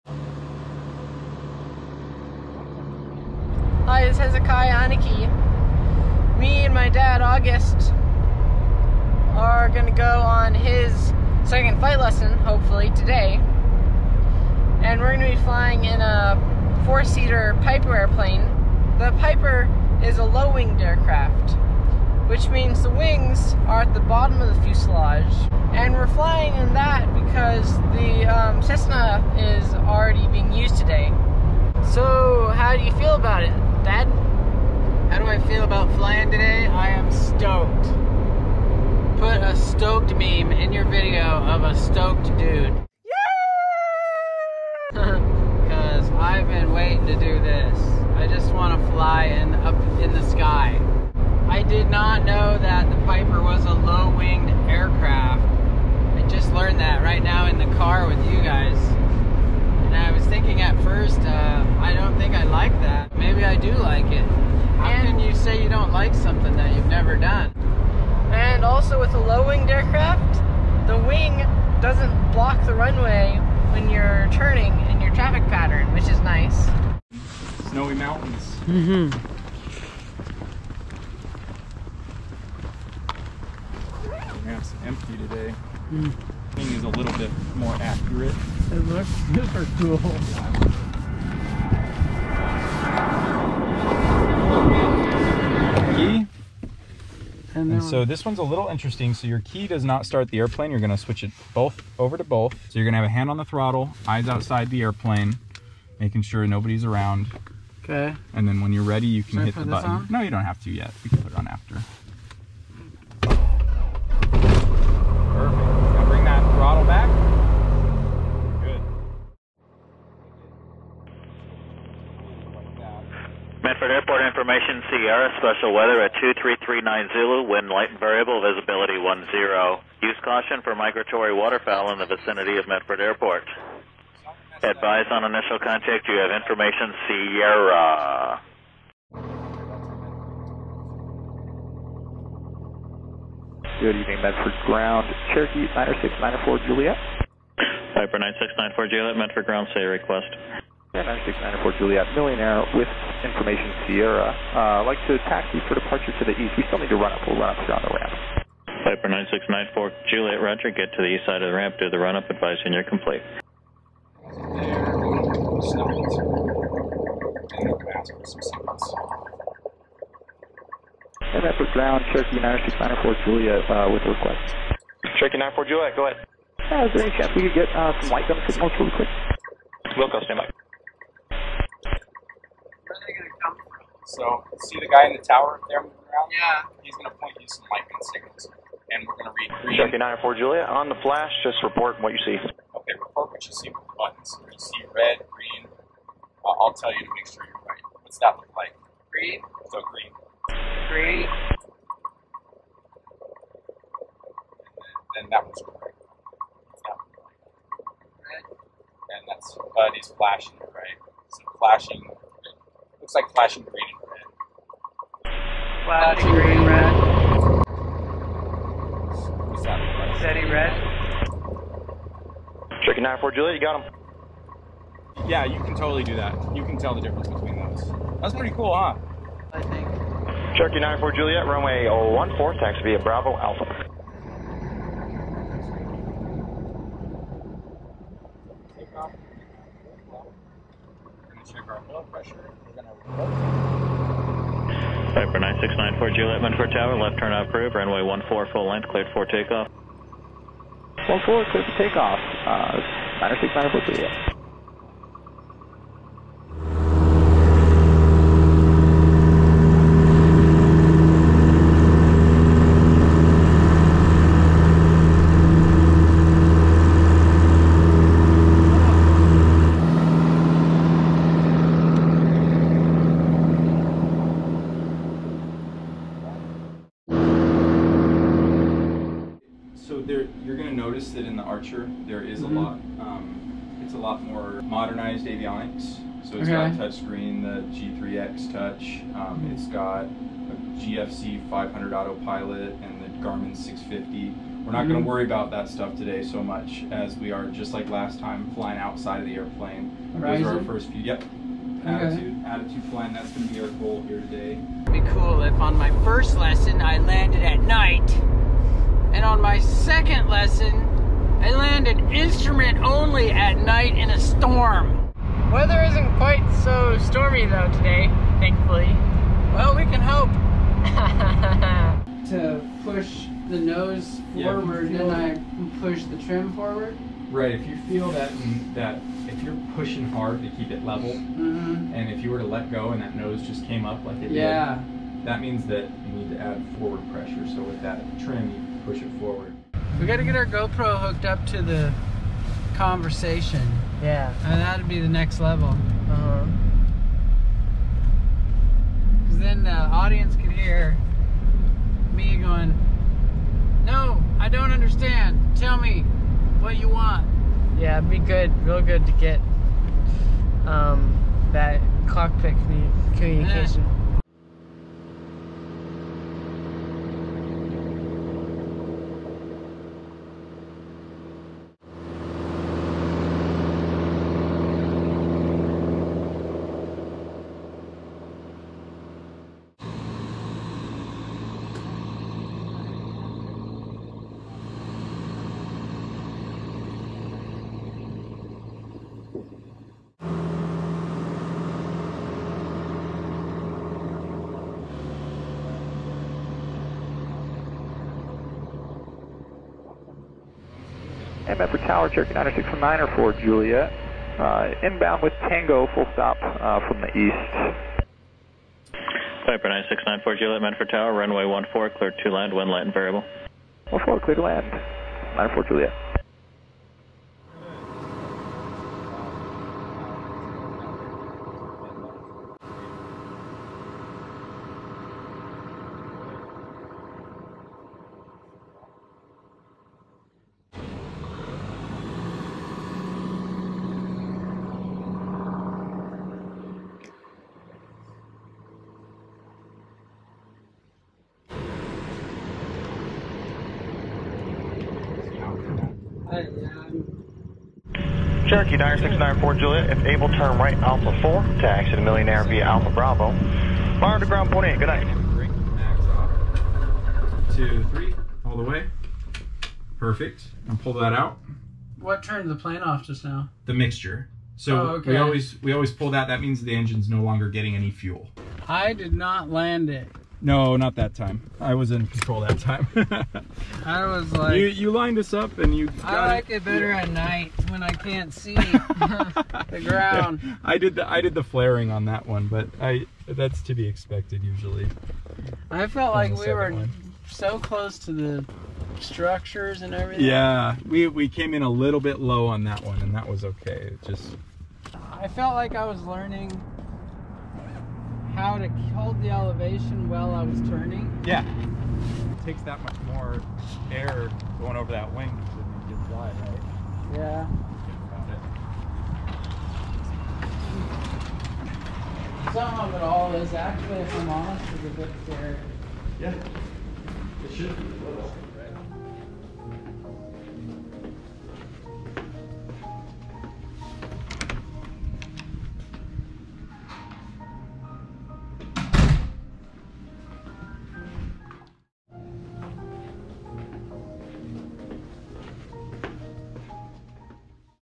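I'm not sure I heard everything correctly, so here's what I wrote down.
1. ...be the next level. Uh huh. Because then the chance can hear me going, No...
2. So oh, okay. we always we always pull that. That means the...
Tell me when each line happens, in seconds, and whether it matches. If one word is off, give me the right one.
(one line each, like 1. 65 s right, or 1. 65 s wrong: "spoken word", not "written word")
1. 344 s wrong: "audience", not "chance"
2. 464 s right.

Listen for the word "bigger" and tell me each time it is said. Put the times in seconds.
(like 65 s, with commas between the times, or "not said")
not said.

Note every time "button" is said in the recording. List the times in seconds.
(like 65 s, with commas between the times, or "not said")
109 s, 193 s.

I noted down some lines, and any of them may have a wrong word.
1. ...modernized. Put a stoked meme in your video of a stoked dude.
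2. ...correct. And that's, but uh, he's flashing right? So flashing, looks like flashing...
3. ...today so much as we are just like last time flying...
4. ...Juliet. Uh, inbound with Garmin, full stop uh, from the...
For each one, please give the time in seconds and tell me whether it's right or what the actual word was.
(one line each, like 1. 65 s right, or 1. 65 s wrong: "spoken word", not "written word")
1. 37 s wrong: "stoked", not "modernized"
2. 205 s right
3. 295 s right
4. 403 s wrong: "Tango", not "Garmin".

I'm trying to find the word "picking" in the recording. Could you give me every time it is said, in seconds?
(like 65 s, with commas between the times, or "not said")
not said.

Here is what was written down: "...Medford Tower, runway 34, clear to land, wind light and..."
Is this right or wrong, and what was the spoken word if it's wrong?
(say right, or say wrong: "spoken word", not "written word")
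wrong: "14", not "34".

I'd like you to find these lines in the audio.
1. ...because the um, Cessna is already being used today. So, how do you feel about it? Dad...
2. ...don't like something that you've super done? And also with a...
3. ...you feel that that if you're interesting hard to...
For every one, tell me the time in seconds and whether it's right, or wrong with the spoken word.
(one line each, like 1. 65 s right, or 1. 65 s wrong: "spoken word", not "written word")
1. 27 s right
2. 65 s wrong: "never", not "super"
3. 327 s wrong: "pushing", not "interesting".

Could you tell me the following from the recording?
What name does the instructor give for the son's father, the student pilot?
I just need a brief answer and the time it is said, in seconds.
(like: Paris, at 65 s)
August, at 7 s.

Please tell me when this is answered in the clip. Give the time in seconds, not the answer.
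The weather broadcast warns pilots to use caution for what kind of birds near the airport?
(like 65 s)
130 s.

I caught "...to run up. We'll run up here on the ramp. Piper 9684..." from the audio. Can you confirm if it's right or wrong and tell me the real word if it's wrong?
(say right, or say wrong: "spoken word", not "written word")
wrong: "9694", not "9684".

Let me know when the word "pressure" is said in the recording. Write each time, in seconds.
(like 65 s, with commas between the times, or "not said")
242 s, 337 s.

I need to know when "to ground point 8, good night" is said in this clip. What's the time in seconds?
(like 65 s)
454 s.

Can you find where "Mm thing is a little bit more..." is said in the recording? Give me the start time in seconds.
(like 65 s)
85 s.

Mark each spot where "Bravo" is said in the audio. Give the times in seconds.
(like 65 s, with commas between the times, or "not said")
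232 s, 452 s.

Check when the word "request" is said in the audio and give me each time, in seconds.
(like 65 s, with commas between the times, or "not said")
149 s, 174 s.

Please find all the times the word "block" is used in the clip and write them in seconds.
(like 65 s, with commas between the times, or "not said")
72 s.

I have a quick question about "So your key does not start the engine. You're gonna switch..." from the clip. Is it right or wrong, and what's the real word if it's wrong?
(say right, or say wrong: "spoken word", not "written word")
wrong: "airplane", not "engine".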